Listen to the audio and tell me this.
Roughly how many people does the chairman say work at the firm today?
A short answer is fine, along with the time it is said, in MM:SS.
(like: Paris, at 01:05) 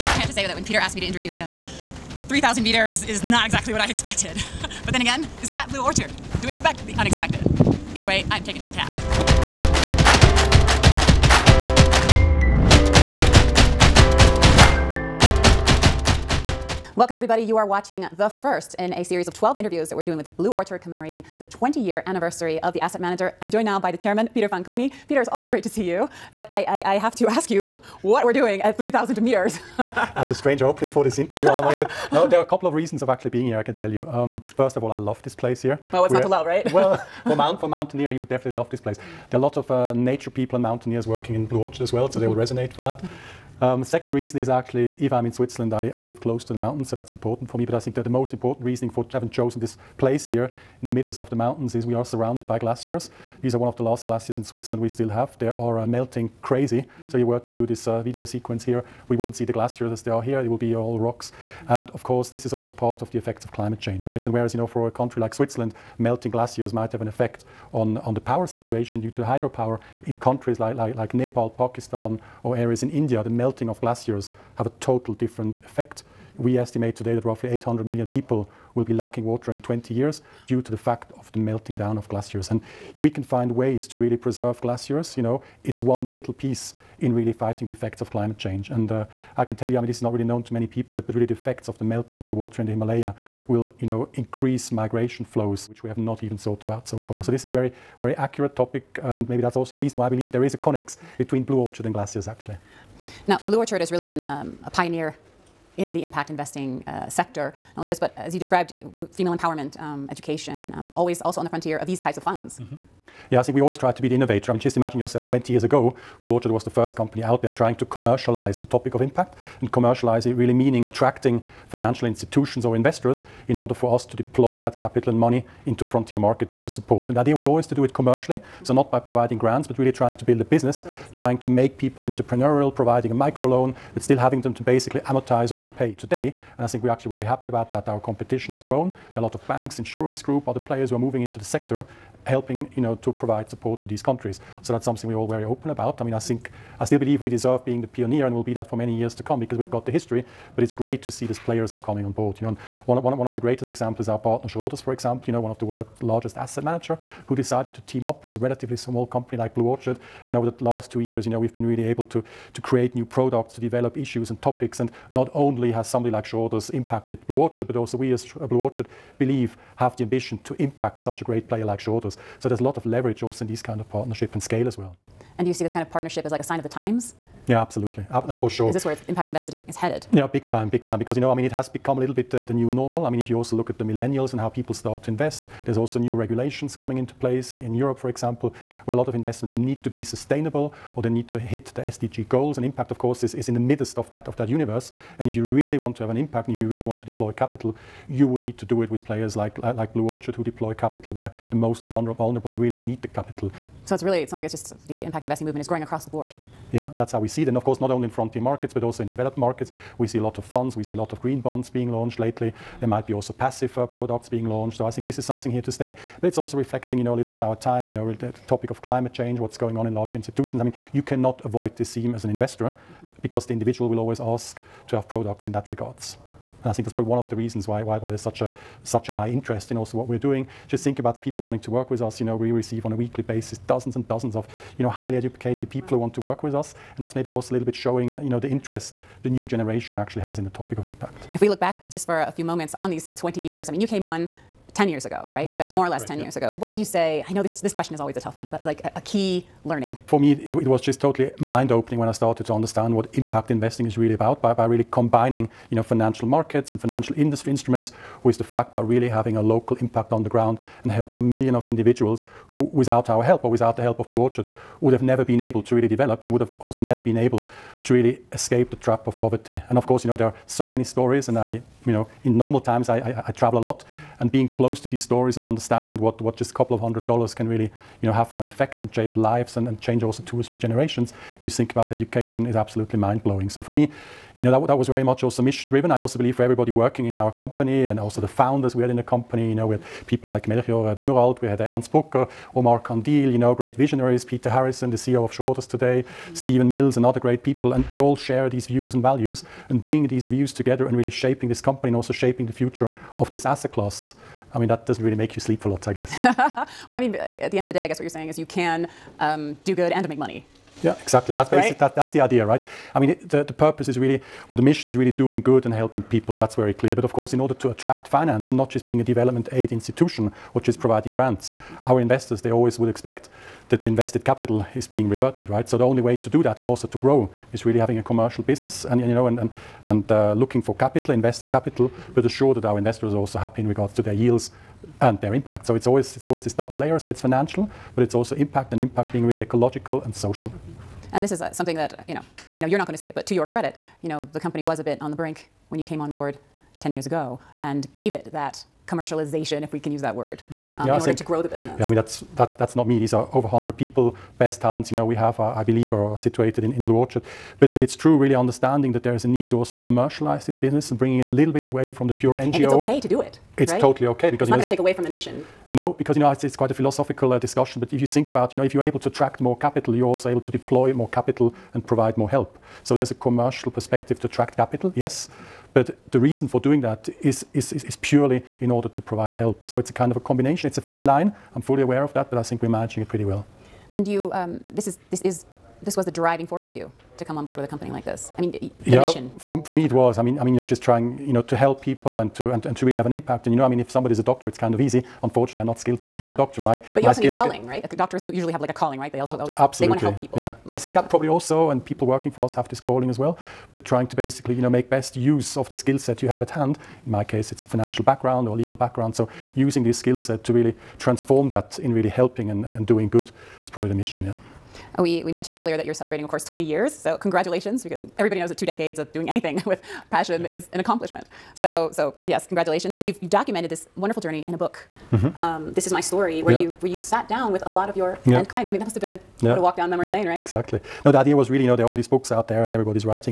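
over 100, at 05:53.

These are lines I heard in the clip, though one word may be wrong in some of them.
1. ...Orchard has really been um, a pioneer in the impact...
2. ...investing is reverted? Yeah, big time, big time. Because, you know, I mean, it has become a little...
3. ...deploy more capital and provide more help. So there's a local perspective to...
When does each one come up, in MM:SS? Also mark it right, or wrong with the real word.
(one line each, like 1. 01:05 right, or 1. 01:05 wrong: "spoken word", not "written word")
1. 01:43 right
2. 02:59 wrong: "headed", not "reverted"
3. 06:10 wrong: "commercial", not "local".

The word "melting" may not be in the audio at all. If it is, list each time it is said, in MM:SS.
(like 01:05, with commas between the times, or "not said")
00:55, 01:05, 01:13, 01:21, 01:31.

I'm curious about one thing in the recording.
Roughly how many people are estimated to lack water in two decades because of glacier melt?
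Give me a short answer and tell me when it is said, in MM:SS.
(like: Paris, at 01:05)
800 million, at 01:17.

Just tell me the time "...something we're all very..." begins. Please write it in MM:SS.
02:24.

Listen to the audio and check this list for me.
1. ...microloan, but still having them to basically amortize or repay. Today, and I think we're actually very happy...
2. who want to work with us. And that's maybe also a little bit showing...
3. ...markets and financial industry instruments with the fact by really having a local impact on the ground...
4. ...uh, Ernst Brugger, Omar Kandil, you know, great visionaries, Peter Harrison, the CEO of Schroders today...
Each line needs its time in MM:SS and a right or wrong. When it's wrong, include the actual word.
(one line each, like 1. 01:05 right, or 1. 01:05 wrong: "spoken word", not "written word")
1. 02:13 right
2. 03:55 right
3. 04:16 right
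4. 04:51 right.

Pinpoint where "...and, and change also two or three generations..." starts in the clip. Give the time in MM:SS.
04:39.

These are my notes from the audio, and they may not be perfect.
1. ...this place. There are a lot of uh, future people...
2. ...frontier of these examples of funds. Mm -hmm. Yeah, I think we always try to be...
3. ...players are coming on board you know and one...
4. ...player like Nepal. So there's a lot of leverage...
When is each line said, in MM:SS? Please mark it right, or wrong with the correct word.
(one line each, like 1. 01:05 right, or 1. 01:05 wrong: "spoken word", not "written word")
1. 00:38 wrong: "nature", not "future"
2. 01:51 wrong: "types", not "examples"
3. 02:31 right
4. 02:51 wrong: "Schroders", not "Nepal".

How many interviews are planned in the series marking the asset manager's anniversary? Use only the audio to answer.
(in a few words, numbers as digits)
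12.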